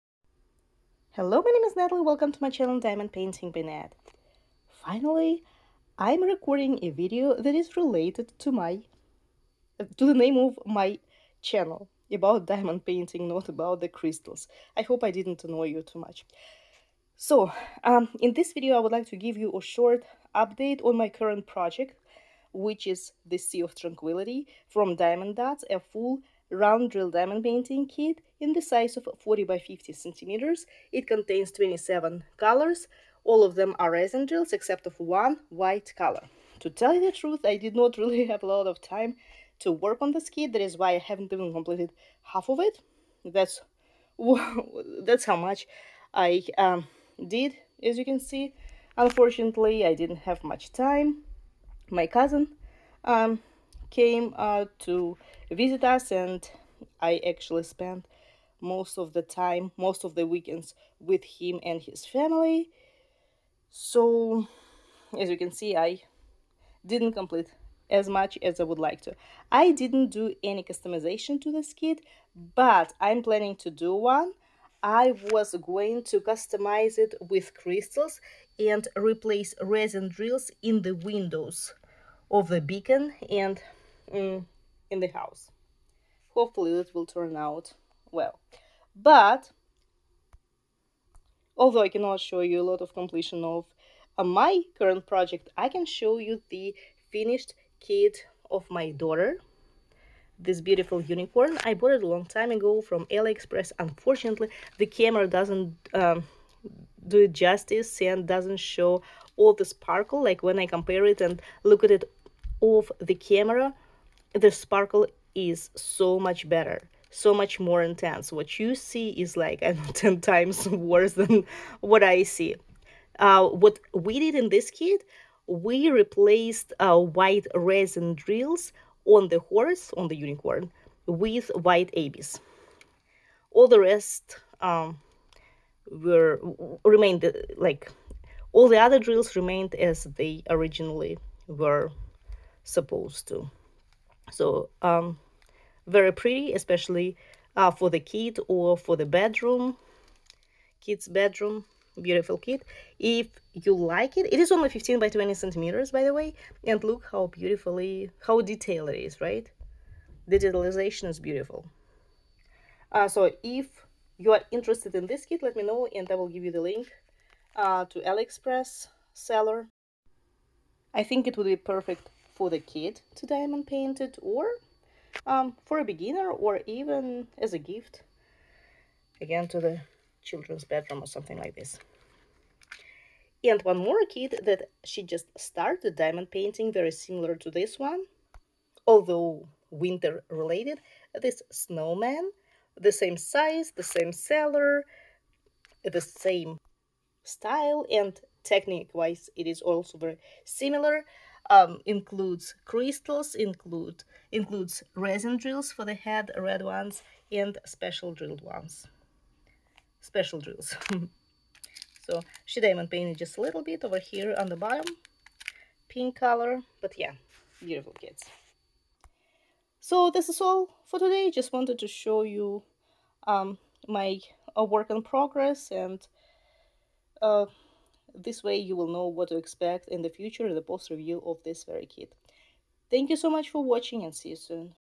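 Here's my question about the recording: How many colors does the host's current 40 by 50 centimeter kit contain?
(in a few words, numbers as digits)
27.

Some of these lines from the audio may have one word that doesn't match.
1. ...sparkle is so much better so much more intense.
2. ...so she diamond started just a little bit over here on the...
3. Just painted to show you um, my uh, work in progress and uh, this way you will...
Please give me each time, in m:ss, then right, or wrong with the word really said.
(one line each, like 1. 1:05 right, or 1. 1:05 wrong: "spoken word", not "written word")
1. 1:54 right
2. 3:32 wrong: "painted", not "started"
3. 3:41 wrong: "wanted", not "painted".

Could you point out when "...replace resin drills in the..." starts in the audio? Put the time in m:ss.
1:18.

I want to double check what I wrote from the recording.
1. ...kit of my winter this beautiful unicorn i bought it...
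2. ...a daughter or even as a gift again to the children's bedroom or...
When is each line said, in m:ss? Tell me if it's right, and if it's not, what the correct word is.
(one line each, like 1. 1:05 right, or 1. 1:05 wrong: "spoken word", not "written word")
1. 1:37 wrong: "daughter", not "winter"
2. 2:55 wrong: "beginner", not "daughter".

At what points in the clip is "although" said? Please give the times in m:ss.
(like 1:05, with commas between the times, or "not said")
1:31, 3:08.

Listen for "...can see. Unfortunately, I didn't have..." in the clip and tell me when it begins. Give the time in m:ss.
0:48.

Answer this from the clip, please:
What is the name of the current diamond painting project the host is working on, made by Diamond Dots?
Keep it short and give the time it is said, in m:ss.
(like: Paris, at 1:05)
Sea of Tranquility, at 0:23.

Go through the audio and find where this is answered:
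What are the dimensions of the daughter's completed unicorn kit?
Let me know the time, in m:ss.
2:34.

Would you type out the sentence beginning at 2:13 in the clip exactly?
All the rest um, were remained like all the other drills remained as they originally were supposed to.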